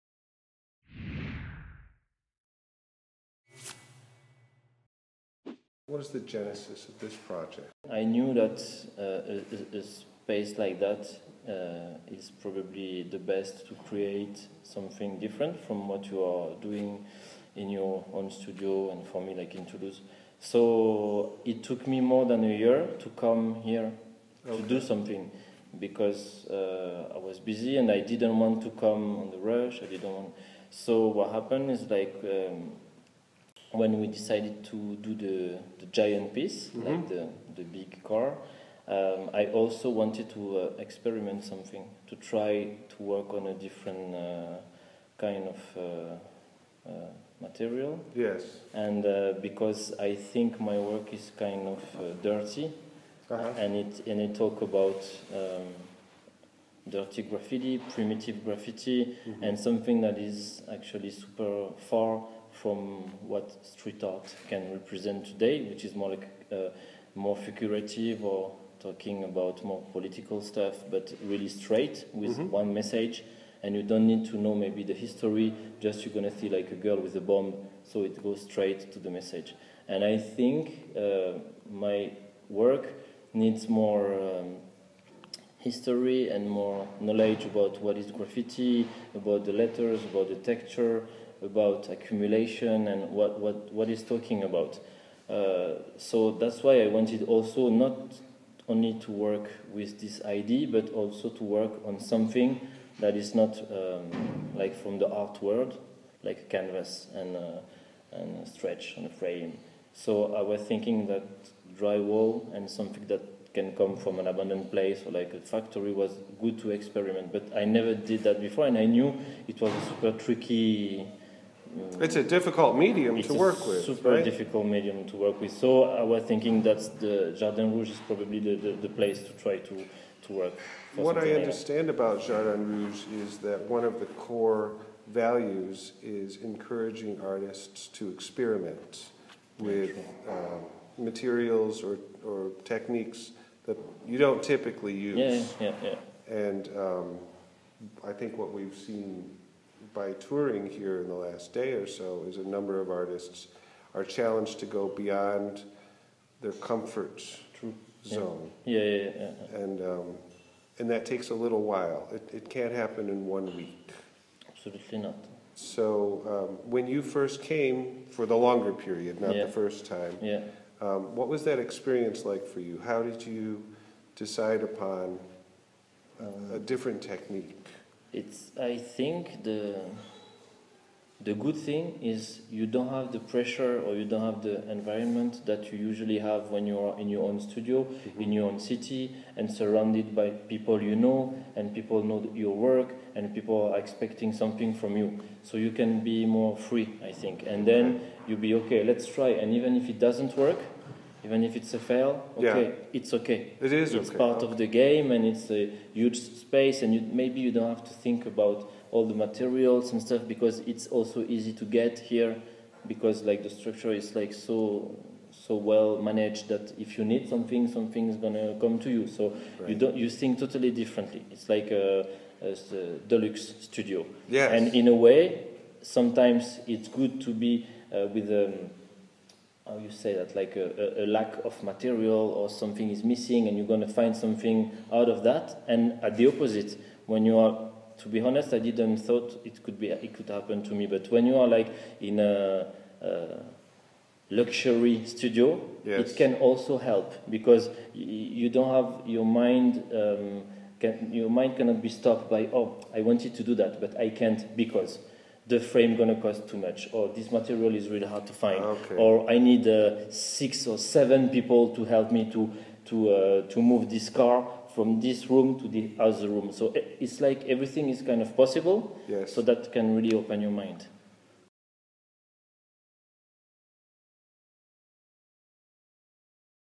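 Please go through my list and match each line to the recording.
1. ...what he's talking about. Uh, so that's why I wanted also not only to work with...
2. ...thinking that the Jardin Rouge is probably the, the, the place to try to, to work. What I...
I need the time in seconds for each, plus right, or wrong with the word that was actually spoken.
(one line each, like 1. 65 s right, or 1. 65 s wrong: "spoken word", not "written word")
1. 93 s right
2. 126 s right.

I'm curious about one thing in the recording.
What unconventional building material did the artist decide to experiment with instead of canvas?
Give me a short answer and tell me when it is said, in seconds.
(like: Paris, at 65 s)
Drywall, at 111 s.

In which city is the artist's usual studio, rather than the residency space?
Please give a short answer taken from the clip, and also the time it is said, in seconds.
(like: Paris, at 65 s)
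Toulouse, at 19 s.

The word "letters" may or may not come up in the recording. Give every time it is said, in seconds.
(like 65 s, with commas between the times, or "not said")
89 s.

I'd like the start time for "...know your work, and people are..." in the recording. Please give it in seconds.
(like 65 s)
192 s.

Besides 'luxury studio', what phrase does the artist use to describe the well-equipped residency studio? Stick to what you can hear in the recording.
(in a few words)
Deluxe studio.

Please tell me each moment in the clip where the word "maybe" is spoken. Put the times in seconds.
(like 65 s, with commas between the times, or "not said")
74 s, 207 s.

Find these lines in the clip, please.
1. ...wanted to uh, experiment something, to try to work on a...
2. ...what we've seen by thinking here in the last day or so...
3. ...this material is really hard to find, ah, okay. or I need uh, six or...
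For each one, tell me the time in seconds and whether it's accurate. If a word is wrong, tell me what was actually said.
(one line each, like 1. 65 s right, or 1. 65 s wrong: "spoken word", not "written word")
1. 39 s right
2. 148 s wrong: "touring", not "thinking"
3. 257 s right.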